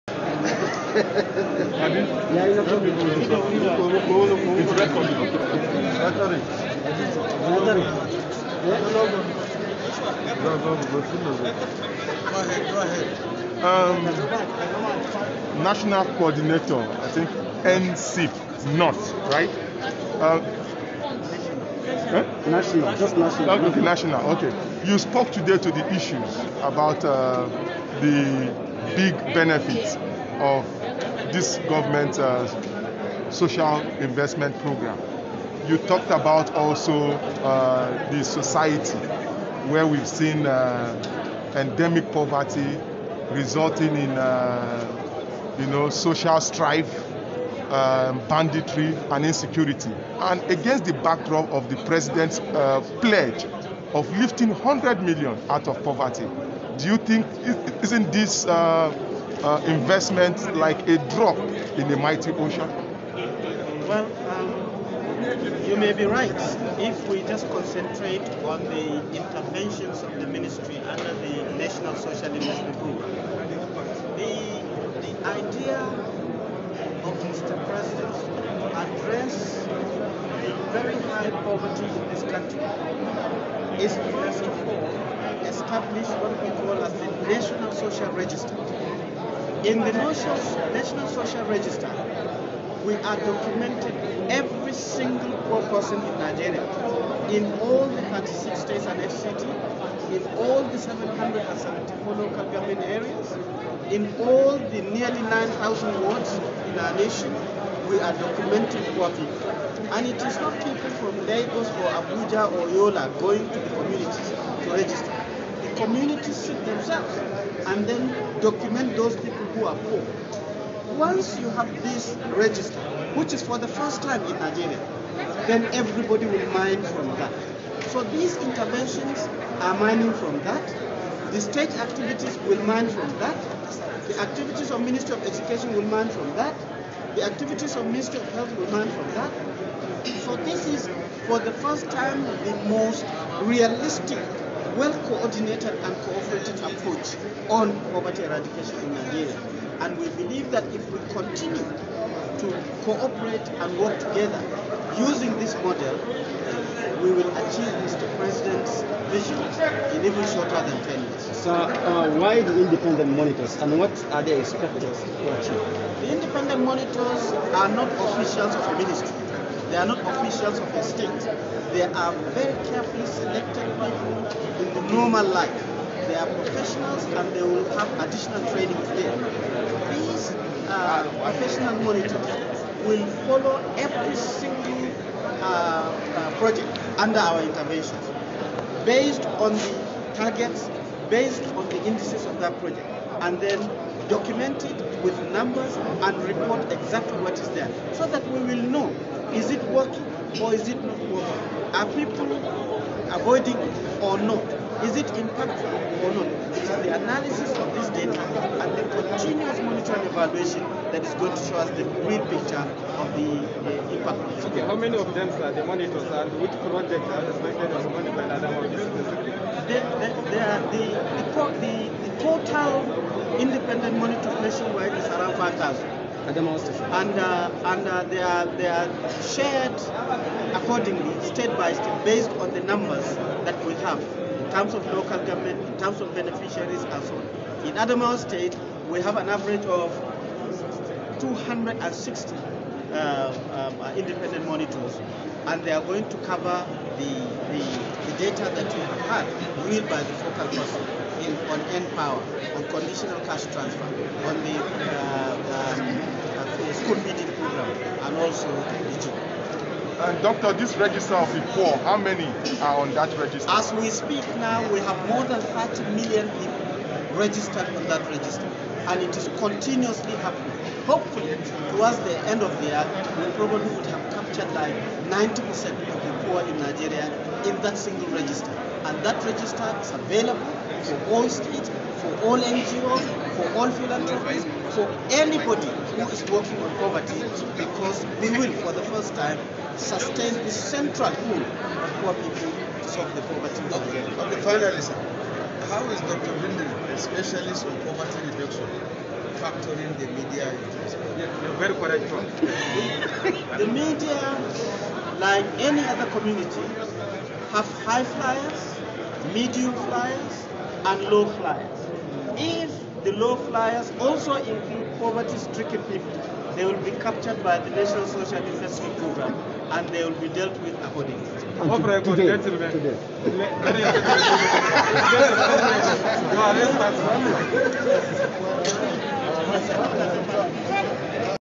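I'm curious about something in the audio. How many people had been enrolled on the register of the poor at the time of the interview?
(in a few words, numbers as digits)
more than 30 million.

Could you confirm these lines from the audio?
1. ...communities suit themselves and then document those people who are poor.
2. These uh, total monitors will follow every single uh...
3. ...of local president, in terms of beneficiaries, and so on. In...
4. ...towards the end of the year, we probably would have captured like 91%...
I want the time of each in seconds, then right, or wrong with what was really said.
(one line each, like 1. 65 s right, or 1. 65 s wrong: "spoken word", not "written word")
1. 115 s right
2. 179 s wrong: "professional", not "total"
3. 234 s wrong: "government", not "president"
4. 271 s wrong: "90", not "91".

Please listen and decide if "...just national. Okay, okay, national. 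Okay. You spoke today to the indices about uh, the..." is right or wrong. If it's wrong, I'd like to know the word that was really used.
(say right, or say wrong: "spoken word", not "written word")
wrong: "issues", not "indices".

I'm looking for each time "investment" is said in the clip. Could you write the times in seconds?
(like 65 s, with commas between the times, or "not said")
33 s, 59 s, 72 s, 318 s.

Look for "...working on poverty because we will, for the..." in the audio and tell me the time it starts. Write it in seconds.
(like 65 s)
286 s.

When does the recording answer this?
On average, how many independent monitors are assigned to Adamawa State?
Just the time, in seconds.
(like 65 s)
241 s.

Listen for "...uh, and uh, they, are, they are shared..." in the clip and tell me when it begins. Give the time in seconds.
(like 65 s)
227 s.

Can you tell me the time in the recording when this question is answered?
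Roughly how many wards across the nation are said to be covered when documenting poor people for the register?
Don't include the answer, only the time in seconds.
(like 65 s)
104 s.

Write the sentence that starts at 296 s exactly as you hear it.
Bindir, a specialist on poverty reduction, factoring the media yeah, you're very correct, John.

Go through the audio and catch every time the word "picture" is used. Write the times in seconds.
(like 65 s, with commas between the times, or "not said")
212 s.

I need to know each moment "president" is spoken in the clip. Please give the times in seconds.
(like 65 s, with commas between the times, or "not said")
51 s, 77 s, 158 s.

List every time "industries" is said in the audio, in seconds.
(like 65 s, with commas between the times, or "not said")
not said.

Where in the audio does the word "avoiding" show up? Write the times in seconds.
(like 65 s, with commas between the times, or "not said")
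203 s.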